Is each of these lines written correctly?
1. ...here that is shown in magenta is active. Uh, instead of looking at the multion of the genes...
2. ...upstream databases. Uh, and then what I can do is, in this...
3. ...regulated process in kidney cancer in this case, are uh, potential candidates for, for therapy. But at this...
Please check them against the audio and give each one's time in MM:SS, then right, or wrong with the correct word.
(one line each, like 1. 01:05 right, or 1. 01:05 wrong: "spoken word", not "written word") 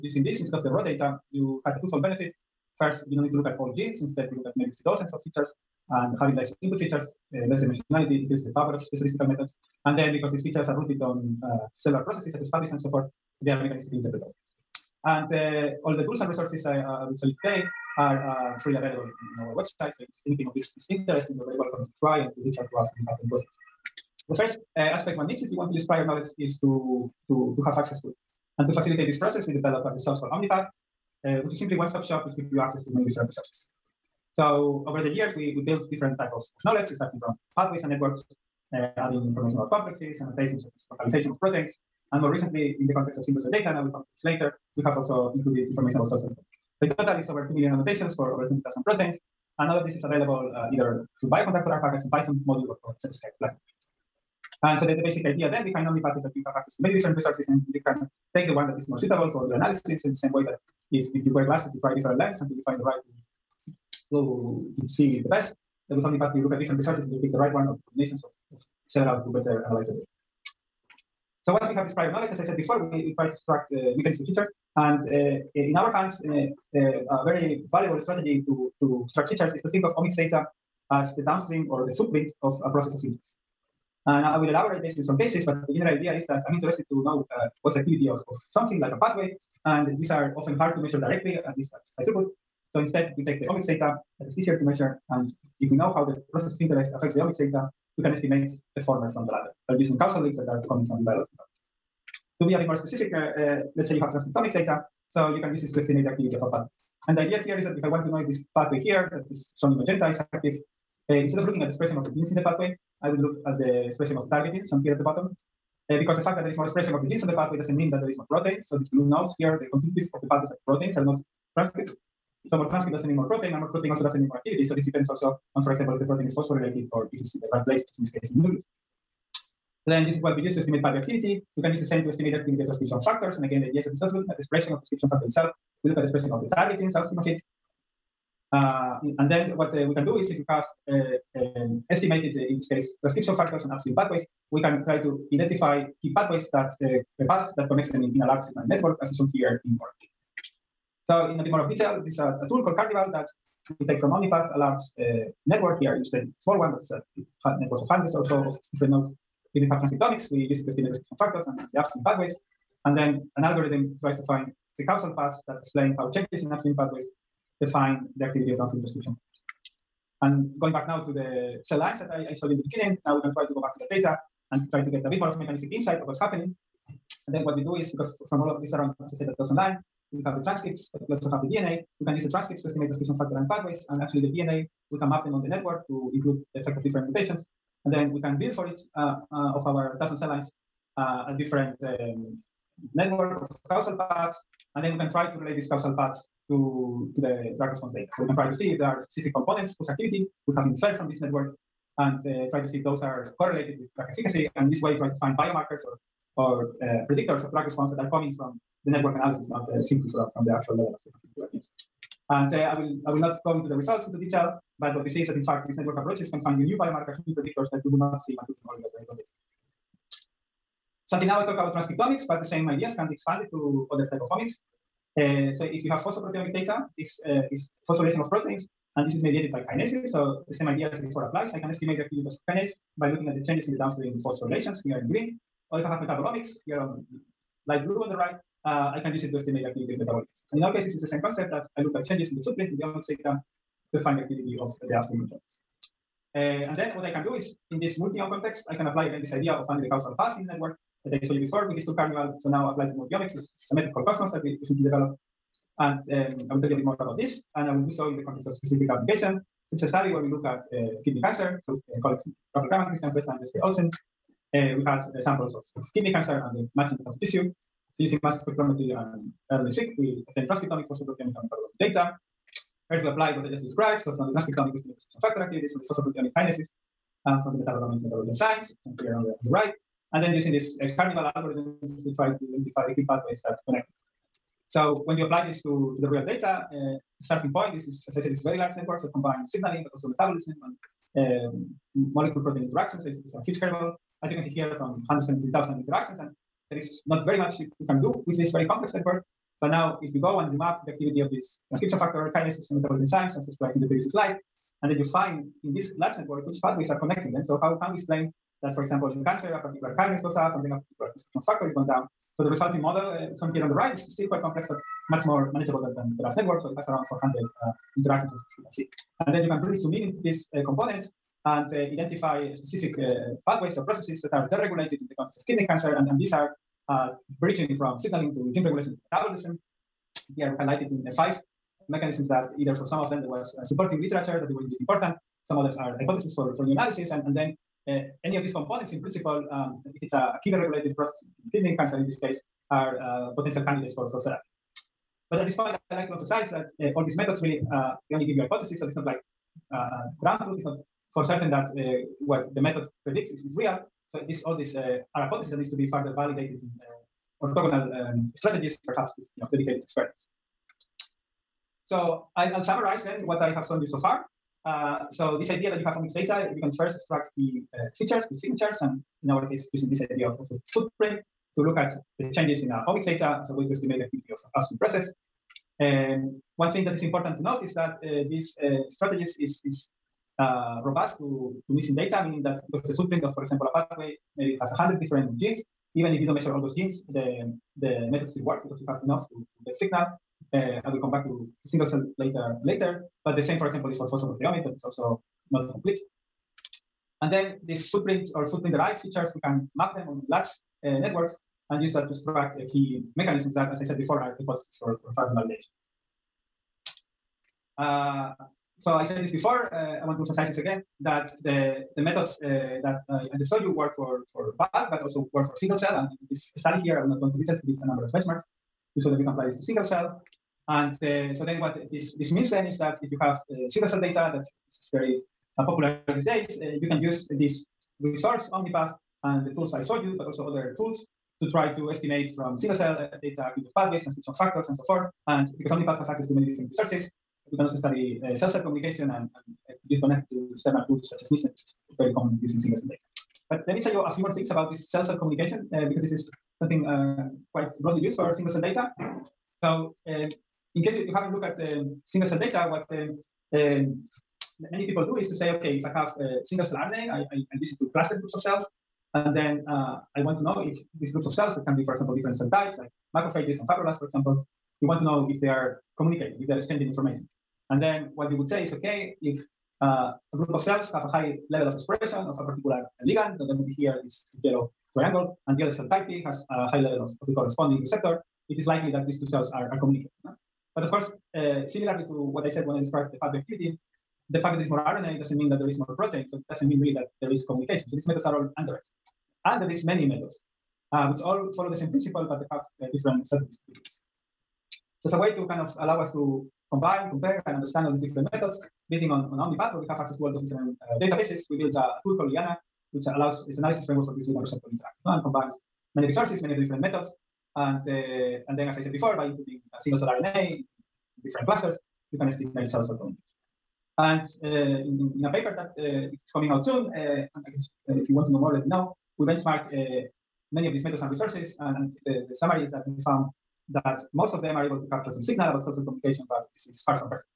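1. 01:48 wrong: "expression", not "multion"
2. 04:04 wrong: "enzymes", not "databases"
3. 05:40 right.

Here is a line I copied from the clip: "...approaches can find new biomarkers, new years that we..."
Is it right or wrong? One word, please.
wrong.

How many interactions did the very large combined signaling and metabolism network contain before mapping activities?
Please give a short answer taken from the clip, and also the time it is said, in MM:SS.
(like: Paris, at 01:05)
170,000, at 04:55.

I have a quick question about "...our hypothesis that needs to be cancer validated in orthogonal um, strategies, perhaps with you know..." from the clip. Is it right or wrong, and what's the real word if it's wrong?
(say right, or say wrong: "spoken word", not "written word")
wrong: "further", not "cancer".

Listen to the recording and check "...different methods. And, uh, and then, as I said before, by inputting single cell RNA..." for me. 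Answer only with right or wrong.
right.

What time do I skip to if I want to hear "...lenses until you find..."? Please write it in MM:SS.
01:02.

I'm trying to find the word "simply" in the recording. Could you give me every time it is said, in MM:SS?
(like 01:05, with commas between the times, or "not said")
00:31, 03:29.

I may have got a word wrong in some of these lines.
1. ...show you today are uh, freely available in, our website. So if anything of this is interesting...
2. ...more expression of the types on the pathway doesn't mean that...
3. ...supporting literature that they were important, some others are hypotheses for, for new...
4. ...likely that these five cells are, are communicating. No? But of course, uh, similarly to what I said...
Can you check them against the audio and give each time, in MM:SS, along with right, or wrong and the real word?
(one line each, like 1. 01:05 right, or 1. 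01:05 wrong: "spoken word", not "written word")
1. 00:17 right
2. 01:56 wrong: "genes", not "types"
3. 05:33 right
4. 07:58 wrong: "two", not "five".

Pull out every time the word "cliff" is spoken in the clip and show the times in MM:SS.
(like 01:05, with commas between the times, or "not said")
not said.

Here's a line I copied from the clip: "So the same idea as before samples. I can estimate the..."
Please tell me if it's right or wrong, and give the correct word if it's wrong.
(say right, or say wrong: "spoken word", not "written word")
wrong: "applies", not "samples".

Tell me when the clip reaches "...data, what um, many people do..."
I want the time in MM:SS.
07:32.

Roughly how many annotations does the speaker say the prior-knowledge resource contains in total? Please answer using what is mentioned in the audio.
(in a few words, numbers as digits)
Over 2 million.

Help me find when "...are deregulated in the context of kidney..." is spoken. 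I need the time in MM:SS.
05:24.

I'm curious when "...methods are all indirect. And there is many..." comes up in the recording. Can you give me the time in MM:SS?
08:08.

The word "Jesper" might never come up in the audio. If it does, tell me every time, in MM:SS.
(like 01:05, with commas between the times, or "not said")
04:23.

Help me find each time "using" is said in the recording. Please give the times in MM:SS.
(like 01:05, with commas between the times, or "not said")
00:00, 01:39, 04:28, 04:40, 06:09, 07:22.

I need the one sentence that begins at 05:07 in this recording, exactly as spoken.
So how can we explain that, for example, in cancer, a particular kinase goes up, and then a factor is going down.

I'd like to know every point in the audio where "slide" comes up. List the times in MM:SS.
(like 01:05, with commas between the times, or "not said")
05:04.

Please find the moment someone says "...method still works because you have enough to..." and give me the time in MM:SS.
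06:28.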